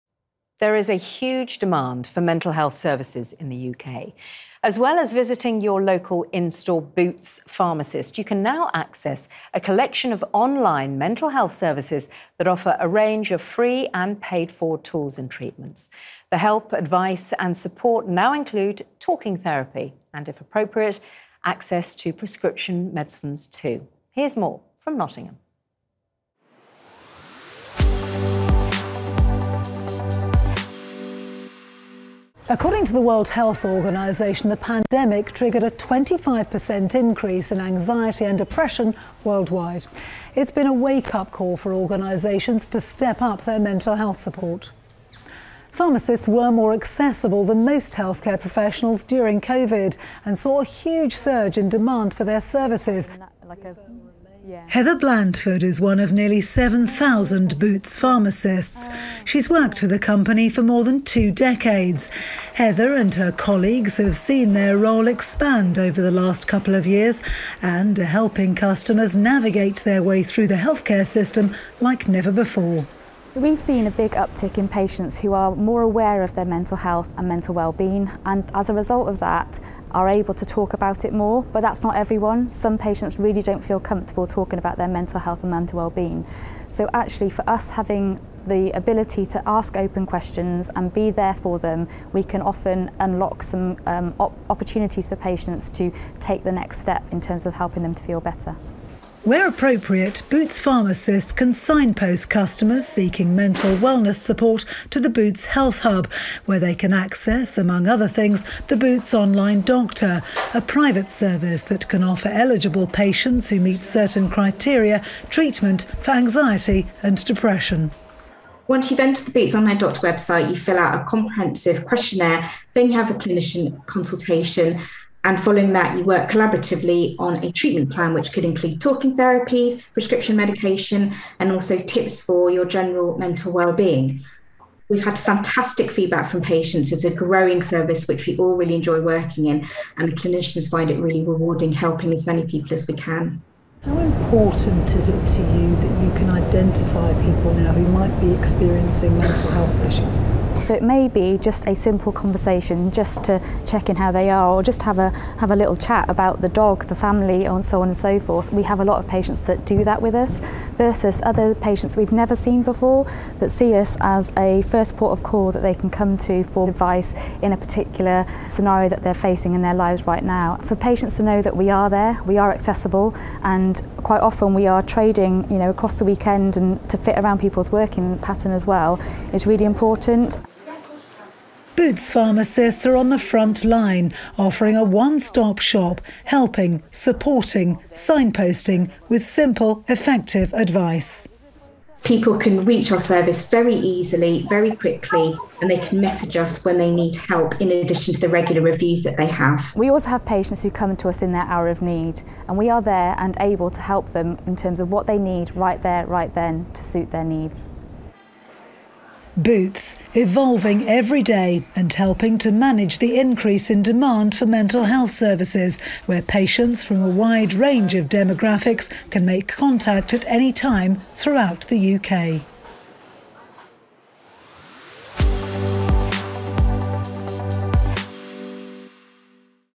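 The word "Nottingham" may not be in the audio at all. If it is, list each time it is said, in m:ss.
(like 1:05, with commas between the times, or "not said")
0:24.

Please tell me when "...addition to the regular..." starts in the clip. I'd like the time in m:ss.
3:17.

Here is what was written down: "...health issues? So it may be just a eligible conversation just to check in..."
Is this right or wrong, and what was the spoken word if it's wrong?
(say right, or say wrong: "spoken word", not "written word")
wrong: "simple", not "eligible".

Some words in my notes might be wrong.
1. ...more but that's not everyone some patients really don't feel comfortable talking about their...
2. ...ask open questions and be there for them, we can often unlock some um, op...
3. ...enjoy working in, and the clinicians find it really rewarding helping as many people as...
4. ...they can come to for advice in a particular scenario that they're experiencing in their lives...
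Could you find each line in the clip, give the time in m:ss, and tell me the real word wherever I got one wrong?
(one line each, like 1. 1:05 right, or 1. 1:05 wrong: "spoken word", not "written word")
1. 1:21 right
2. 1:29 right
3. 2:18 right
4. 2:45 wrong: "facing", not "experiencing".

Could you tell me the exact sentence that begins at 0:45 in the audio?
Pharmacists were more accessible than most healthcare professionals during COVID and saw a huge surge in demand for their services.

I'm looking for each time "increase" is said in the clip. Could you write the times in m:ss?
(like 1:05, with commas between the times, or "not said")
0:36, 3:33.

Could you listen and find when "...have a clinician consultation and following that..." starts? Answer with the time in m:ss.
2:02.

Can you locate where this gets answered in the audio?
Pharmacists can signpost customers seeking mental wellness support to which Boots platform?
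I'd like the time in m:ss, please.
1:45.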